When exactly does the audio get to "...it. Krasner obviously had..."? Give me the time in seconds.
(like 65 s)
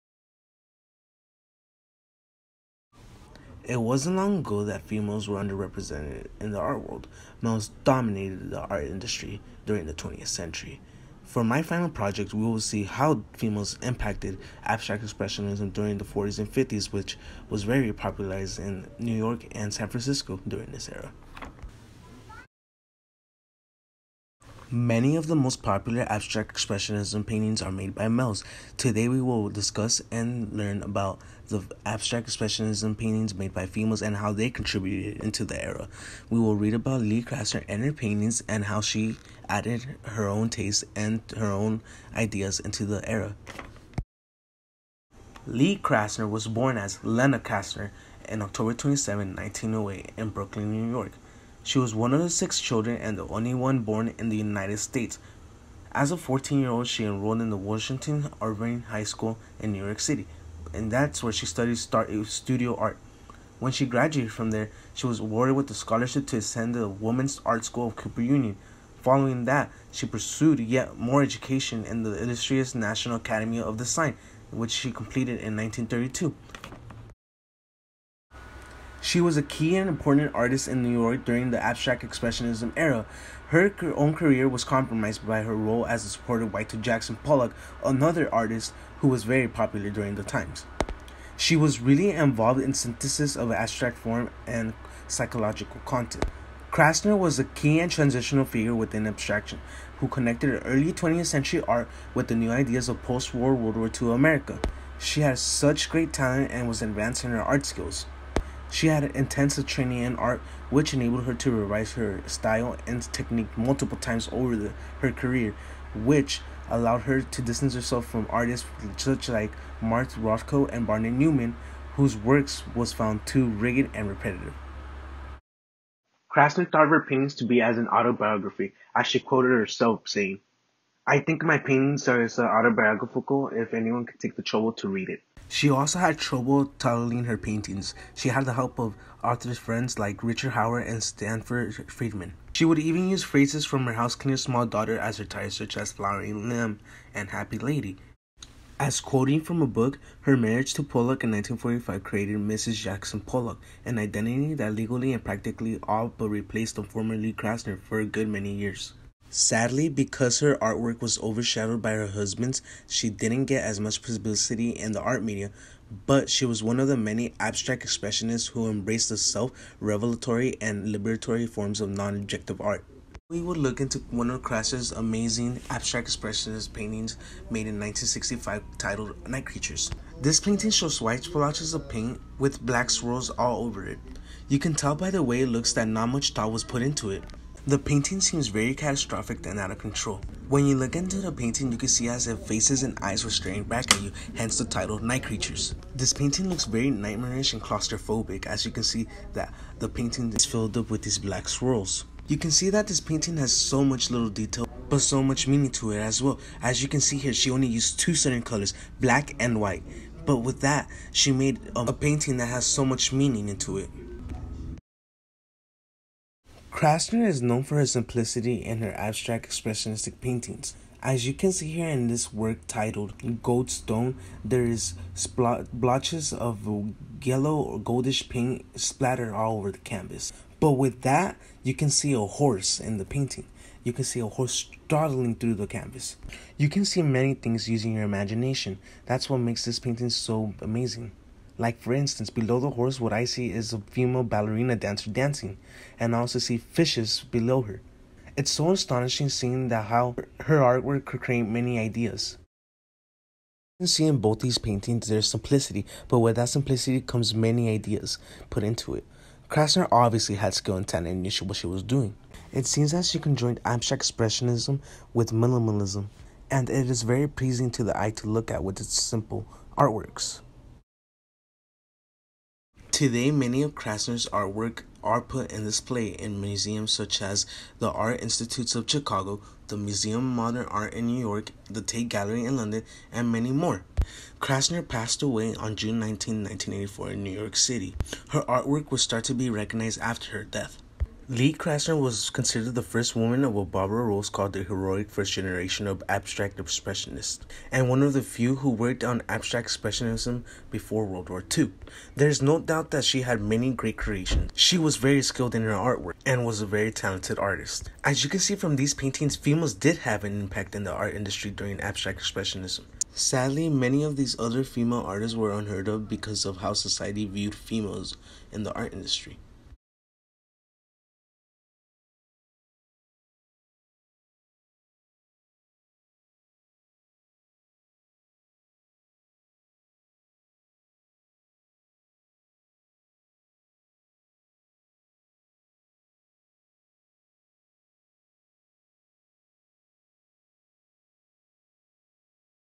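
258 s.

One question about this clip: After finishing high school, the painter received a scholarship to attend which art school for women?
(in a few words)
Women's Art School of Cooper Union.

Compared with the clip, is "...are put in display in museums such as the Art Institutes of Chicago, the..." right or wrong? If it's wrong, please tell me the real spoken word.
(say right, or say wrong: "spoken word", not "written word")
right.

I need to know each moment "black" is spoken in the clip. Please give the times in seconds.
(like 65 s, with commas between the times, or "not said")
182 s, 201 s, 208 s.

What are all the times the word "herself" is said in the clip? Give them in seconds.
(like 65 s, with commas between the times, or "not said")
117 s, 129 s.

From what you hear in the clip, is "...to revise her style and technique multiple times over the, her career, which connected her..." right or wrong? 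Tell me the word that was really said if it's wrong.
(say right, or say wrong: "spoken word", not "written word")
wrong: "allowed", not "connected".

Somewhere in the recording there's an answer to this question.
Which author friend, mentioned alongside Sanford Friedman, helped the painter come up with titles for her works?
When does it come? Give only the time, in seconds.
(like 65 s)
140 s.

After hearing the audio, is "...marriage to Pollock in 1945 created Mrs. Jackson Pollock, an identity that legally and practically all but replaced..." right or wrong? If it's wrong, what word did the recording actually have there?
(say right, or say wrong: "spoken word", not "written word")
right.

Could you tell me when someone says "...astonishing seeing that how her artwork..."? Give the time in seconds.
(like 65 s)
248 s.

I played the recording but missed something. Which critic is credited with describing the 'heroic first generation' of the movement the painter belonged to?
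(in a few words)
Barbara Rose.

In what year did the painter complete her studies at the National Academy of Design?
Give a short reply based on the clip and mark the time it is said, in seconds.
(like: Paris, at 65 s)
1932, at 75 s.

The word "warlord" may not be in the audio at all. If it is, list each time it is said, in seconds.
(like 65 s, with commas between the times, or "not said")
not said.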